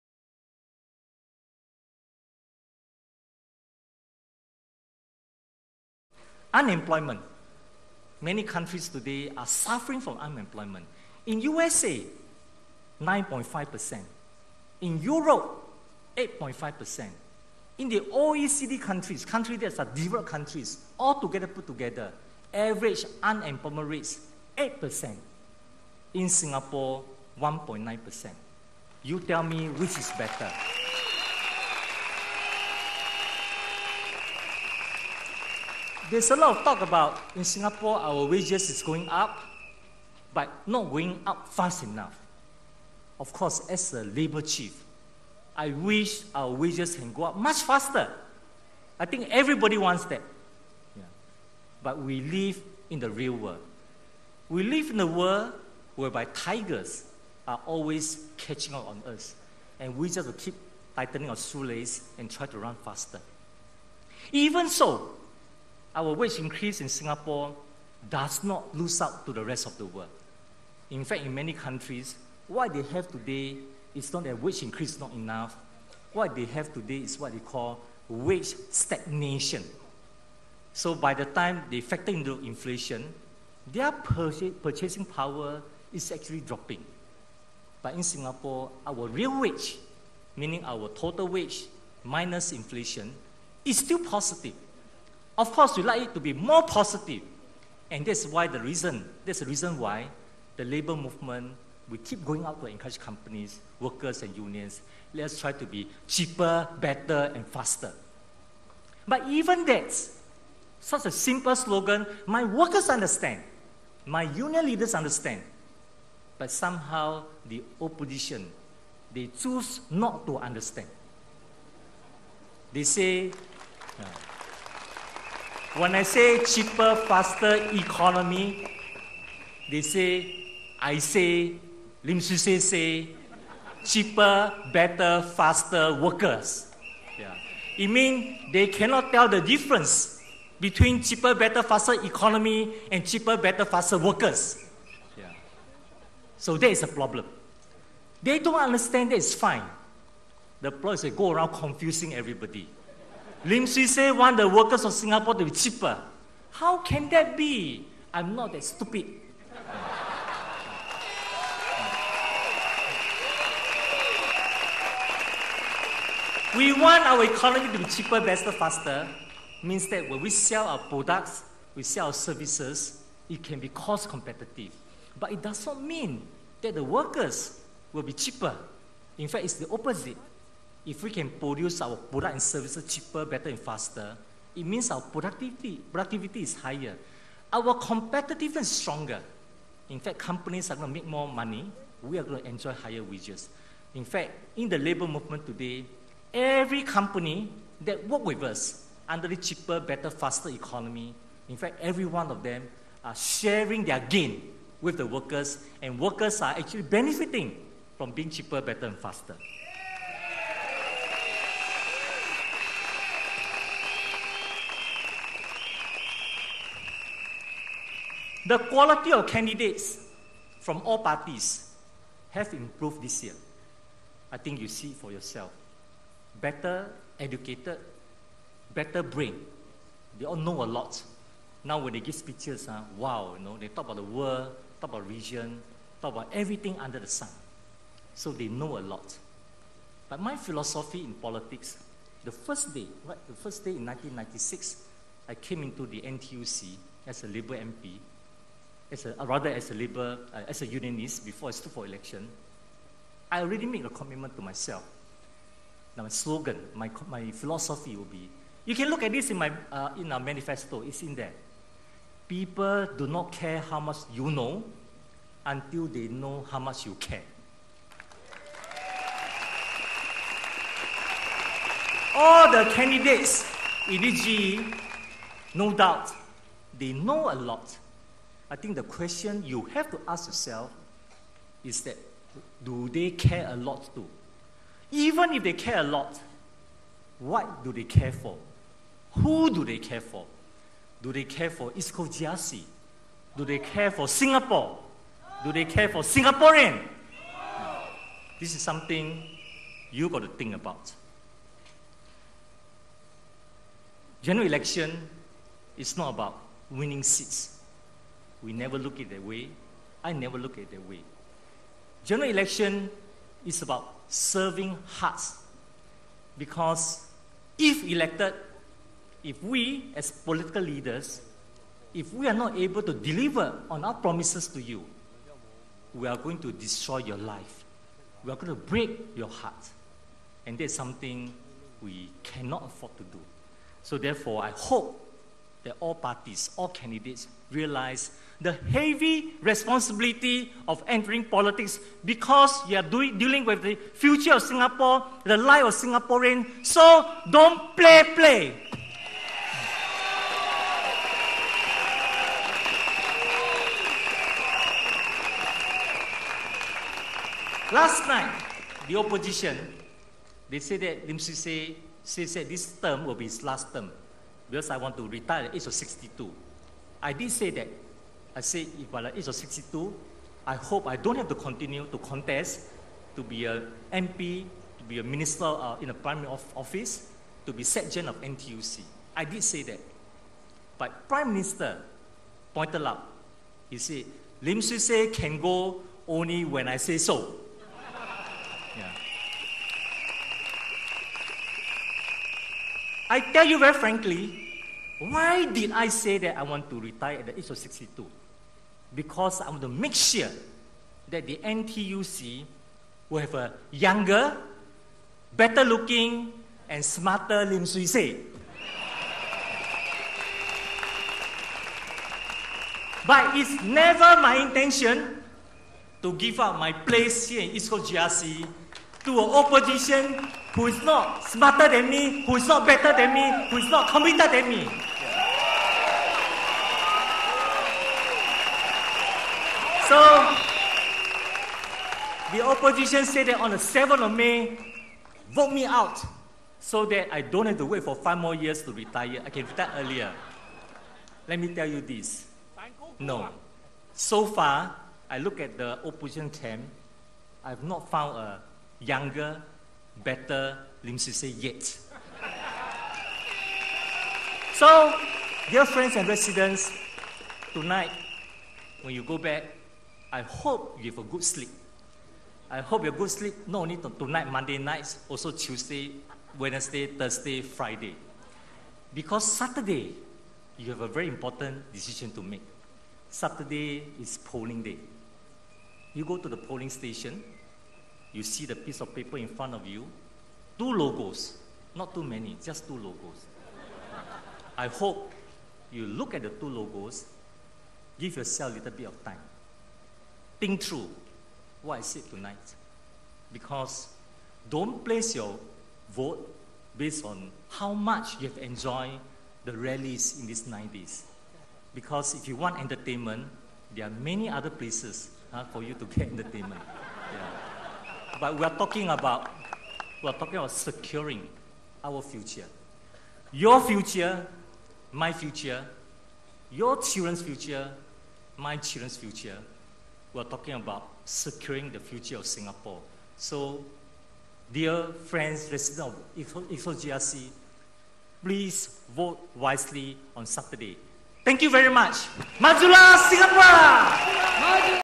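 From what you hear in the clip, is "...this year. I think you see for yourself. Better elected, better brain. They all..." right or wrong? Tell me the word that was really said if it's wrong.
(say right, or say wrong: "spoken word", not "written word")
wrong: "educated", not "elected".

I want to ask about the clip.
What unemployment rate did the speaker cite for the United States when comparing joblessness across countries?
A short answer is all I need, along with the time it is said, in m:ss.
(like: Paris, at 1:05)
9.5%, at 0:13.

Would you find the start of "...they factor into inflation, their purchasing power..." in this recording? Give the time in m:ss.
1:21.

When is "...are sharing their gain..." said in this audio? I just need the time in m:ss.
3:23.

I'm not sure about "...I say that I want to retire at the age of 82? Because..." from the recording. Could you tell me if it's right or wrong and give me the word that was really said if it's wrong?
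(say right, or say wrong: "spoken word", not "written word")
wrong: "62", not "82".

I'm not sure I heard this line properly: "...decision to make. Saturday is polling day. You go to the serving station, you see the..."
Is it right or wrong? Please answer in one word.
wrong.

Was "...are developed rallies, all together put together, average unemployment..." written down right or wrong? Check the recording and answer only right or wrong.
wrong.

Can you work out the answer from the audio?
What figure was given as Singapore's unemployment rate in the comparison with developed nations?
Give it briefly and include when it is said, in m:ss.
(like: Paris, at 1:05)
1.9%, at 0:27.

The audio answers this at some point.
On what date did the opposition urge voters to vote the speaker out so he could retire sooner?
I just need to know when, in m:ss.
7:13.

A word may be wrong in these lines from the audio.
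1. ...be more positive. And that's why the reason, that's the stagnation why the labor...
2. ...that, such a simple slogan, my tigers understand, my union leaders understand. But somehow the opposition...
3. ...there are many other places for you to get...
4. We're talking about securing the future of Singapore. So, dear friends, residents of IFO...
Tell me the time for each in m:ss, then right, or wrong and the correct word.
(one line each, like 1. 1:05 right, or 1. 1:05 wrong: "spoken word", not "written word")
1. 1:36 wrong: "reason", not "stagnation"
2. 1:49 wrong: "workers", not "tigers"
3. 8:23 right
4. 8:40 right.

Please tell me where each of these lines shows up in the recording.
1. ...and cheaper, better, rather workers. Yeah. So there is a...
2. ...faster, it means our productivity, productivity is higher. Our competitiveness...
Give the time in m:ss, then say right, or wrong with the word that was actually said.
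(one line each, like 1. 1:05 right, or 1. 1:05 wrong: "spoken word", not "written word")
1. 2:22 wrong: "faster", not "rather"
2. 3:03 right.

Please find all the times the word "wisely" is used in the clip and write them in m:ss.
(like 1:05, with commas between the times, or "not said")
8:49.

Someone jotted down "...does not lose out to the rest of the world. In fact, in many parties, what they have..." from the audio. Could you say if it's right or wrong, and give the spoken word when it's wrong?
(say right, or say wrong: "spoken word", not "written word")
wrong: "countries", not "parties".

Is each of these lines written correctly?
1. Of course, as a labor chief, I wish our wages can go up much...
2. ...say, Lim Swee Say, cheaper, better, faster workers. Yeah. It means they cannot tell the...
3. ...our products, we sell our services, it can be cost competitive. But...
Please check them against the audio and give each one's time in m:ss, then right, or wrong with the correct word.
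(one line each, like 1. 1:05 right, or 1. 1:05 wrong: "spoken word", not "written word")
1. 0:43 right
2. 2:10 right
3. 2:50 right.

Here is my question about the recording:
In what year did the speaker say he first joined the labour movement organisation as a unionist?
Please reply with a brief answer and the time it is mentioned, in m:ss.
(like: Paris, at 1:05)
1996, at 4:03.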